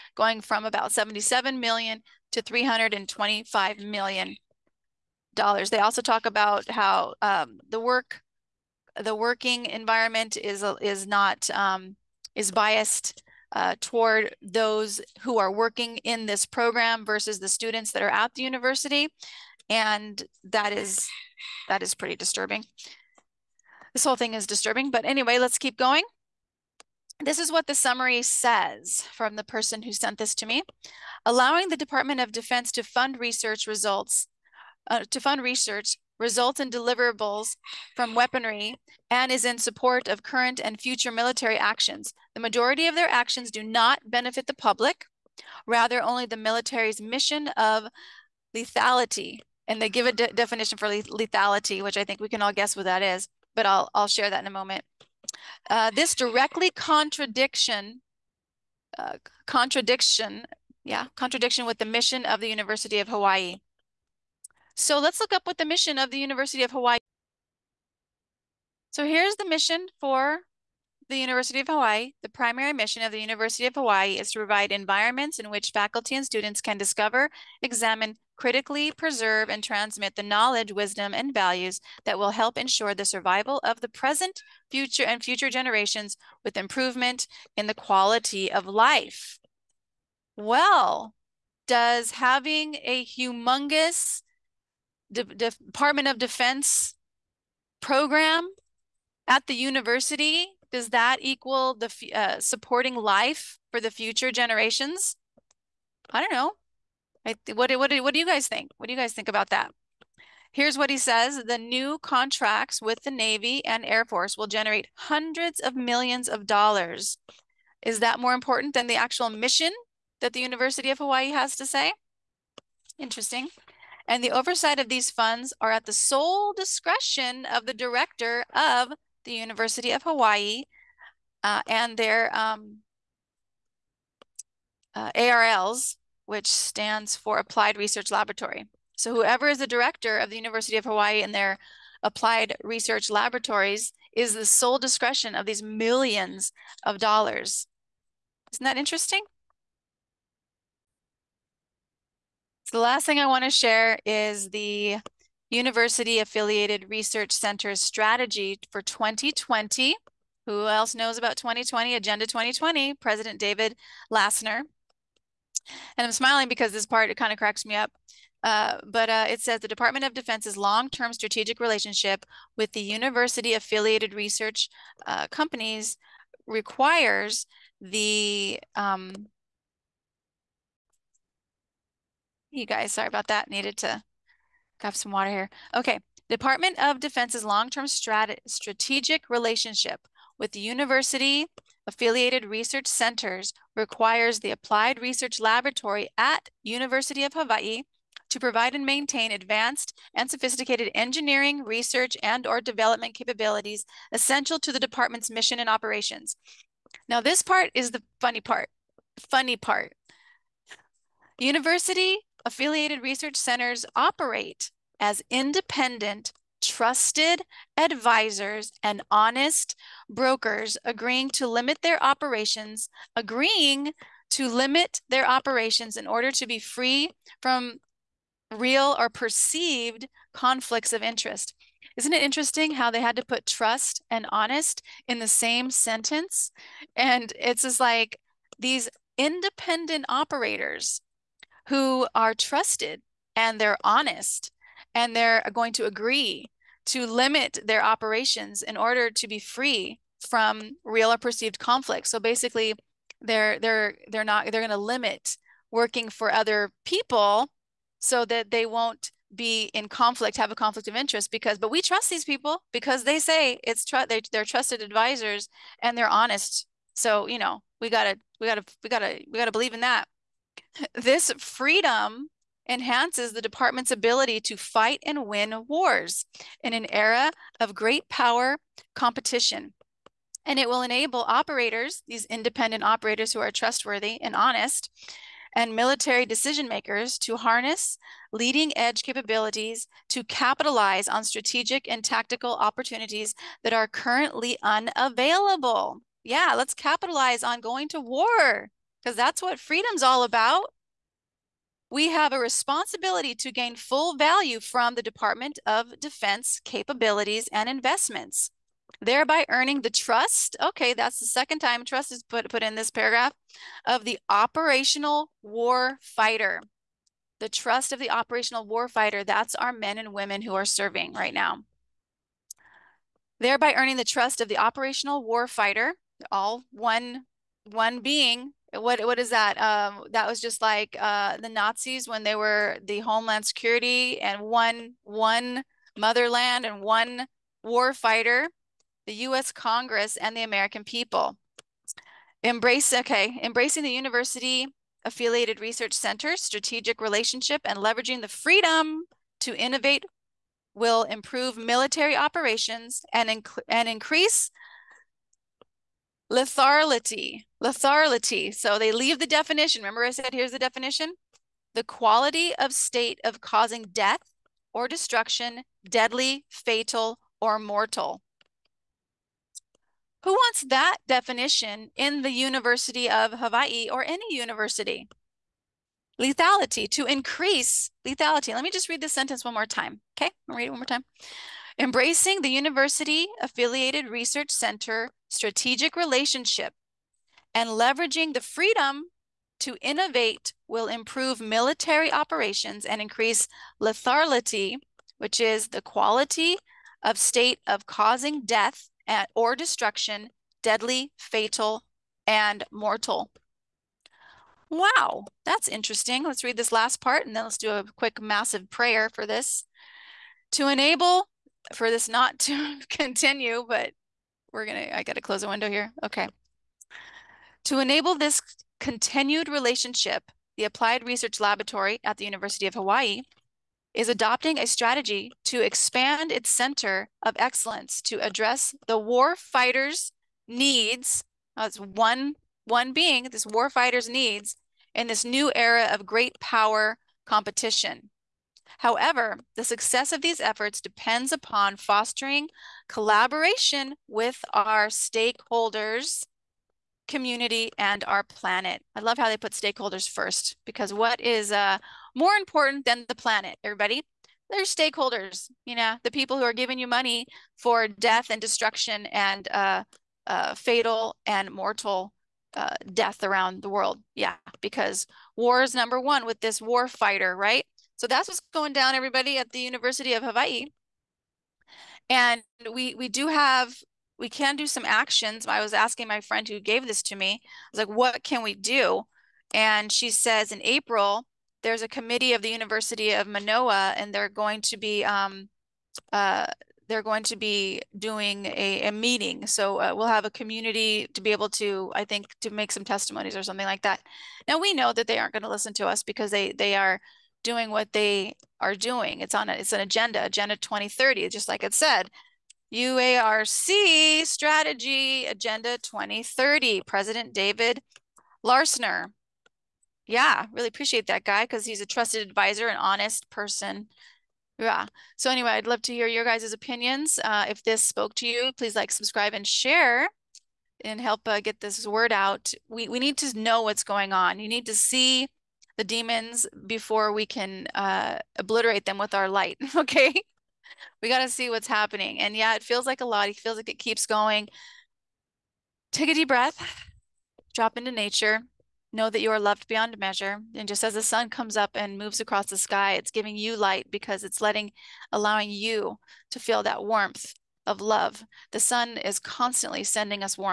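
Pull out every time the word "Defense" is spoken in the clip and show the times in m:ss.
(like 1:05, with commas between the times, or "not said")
0:32, 1:36, 2:50, 3:06, 5:05.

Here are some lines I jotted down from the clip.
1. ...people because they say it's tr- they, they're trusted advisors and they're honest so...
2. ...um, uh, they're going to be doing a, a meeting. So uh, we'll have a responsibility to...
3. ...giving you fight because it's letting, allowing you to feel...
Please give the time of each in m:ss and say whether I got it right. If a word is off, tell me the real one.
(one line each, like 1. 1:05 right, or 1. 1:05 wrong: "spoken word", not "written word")
1. 4:22 right
2. 8:05 wrong: "community", not "responsibility"
3. 9:03 wrong: "light", not "fight".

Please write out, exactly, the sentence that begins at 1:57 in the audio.
Is that more important than the actual mission that the University of Hawaii has to say?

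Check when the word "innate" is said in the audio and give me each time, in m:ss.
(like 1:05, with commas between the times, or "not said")
not said.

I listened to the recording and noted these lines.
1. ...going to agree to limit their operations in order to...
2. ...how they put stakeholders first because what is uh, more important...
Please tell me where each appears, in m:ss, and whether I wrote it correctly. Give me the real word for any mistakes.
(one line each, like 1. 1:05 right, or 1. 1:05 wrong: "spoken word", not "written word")
1. 4:05 right
2. 7:29 right.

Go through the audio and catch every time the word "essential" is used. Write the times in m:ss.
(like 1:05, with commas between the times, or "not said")
3:24.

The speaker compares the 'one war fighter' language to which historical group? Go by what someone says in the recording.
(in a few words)
the Nazis.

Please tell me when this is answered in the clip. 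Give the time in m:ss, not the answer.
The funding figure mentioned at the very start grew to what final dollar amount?
0:02.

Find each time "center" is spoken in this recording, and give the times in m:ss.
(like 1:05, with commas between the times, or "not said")
2:37, 3:12, 3:33, 5:45, 6:24, 7:06.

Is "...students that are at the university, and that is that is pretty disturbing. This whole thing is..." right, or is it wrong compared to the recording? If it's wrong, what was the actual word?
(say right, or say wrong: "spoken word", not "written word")
right.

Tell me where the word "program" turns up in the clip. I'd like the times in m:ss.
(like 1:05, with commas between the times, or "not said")
0:16, 1:37.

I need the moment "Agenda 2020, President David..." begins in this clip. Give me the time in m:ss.
2:41.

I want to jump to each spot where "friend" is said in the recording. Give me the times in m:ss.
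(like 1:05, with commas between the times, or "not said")
7:56.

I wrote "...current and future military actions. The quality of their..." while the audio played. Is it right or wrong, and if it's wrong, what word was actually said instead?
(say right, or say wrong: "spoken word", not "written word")
wrong: "majority", not "quality".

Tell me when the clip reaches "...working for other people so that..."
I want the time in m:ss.
4:15.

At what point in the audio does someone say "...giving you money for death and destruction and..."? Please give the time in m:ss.
7:36.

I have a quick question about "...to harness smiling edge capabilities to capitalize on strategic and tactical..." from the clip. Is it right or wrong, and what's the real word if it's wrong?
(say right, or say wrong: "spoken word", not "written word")
wrong: "leading", not "smiling".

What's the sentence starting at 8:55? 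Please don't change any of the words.
Take a deep breath, drop into nature.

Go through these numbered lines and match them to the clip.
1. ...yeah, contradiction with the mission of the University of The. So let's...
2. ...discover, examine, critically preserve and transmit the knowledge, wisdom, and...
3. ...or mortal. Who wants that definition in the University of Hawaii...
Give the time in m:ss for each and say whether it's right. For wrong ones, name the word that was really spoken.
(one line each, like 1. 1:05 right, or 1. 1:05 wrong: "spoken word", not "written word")
1. 1:00 wrong: "Hawaii", not "The"
2. 1:16 right
3. 6:07 right.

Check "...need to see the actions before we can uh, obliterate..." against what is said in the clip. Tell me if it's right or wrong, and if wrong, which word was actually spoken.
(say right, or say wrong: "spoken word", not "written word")
wrong: "demons", not "actions".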